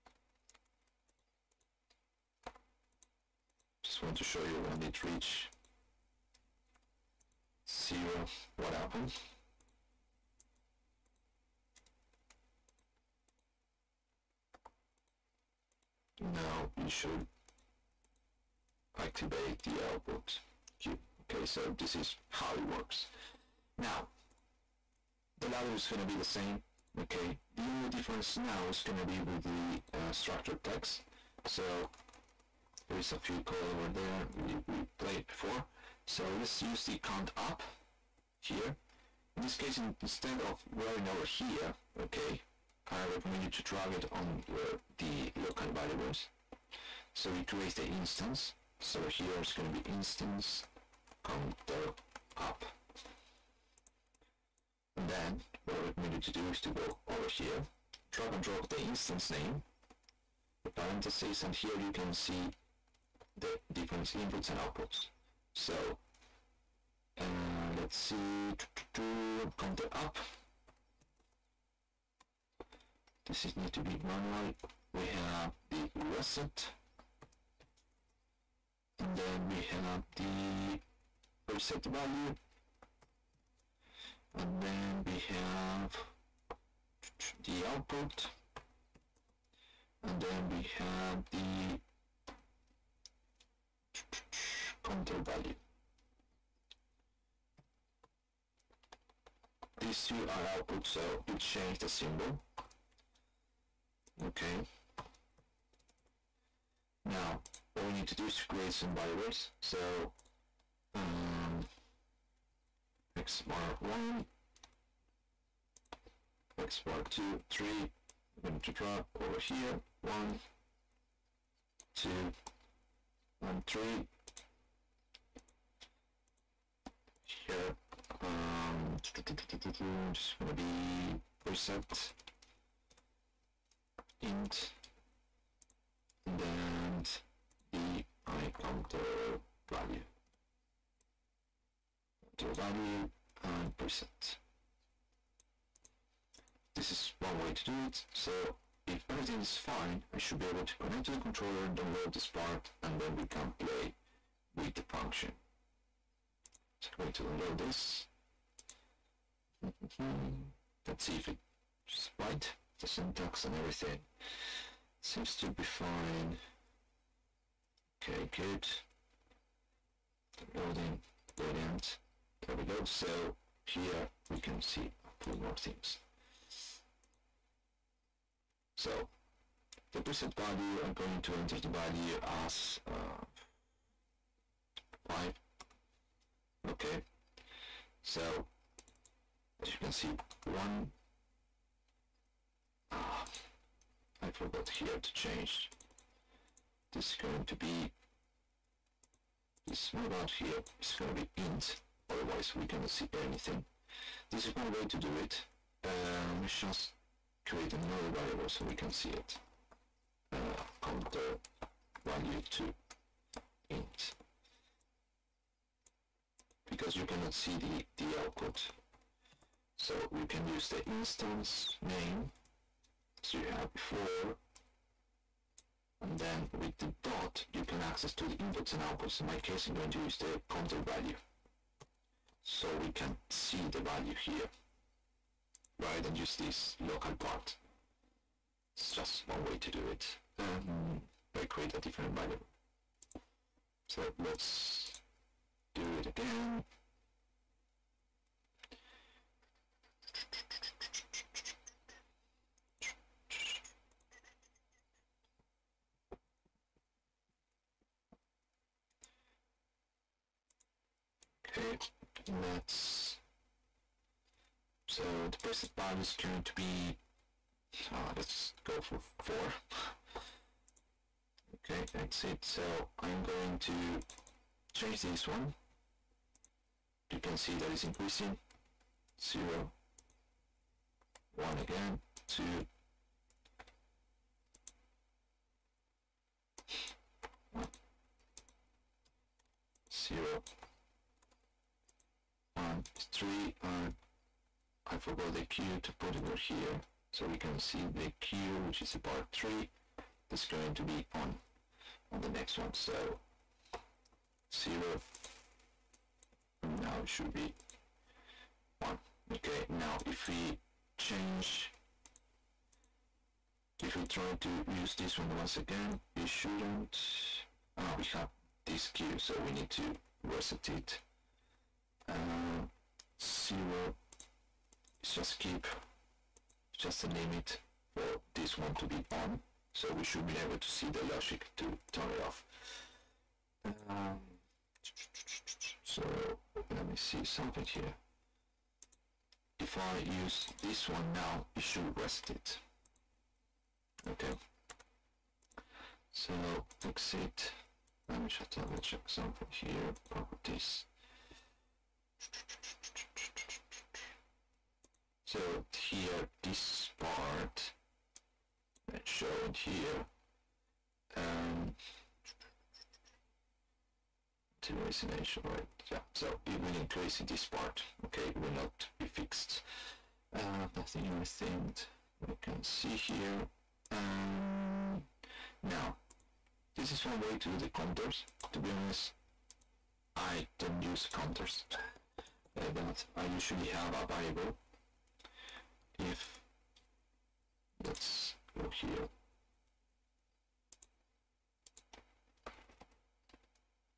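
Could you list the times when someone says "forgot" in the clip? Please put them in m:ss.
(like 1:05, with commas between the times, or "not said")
3:14, 4:54.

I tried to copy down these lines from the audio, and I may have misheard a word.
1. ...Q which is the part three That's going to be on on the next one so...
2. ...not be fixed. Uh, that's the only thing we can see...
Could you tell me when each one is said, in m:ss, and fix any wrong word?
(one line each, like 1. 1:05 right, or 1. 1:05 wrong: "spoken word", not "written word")
1. 4:58 right
2. 6:08 right.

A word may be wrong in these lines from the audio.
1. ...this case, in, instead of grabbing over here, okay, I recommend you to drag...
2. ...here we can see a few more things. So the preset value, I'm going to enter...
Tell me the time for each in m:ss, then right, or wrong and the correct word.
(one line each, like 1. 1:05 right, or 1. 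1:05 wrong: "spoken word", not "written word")
1. 0:39 right
2. 2:53 right.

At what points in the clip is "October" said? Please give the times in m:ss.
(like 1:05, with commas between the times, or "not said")
not said.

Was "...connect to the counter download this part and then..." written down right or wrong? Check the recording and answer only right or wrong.
wrong.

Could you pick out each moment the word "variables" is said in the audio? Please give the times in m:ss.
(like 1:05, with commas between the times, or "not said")
0:45, 1:48, 3:28, 6:24.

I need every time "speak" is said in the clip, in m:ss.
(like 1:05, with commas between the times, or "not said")
not said.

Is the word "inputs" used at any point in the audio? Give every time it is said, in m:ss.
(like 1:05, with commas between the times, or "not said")
1:04, 3:48.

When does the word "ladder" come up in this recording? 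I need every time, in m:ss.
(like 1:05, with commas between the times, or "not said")
0:25.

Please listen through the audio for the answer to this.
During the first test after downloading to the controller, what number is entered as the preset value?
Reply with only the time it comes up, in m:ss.
3:05.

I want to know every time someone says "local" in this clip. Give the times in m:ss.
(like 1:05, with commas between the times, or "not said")
0:45, 3:56.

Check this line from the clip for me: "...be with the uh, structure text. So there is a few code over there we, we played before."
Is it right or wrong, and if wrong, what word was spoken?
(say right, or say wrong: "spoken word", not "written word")
right.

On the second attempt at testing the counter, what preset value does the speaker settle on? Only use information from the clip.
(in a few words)
4.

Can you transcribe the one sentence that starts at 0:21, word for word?
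Okay, so this is how it works.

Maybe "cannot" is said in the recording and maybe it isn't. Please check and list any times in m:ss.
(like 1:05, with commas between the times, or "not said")
3:22, 3:37.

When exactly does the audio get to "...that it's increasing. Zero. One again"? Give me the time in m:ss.
4:37.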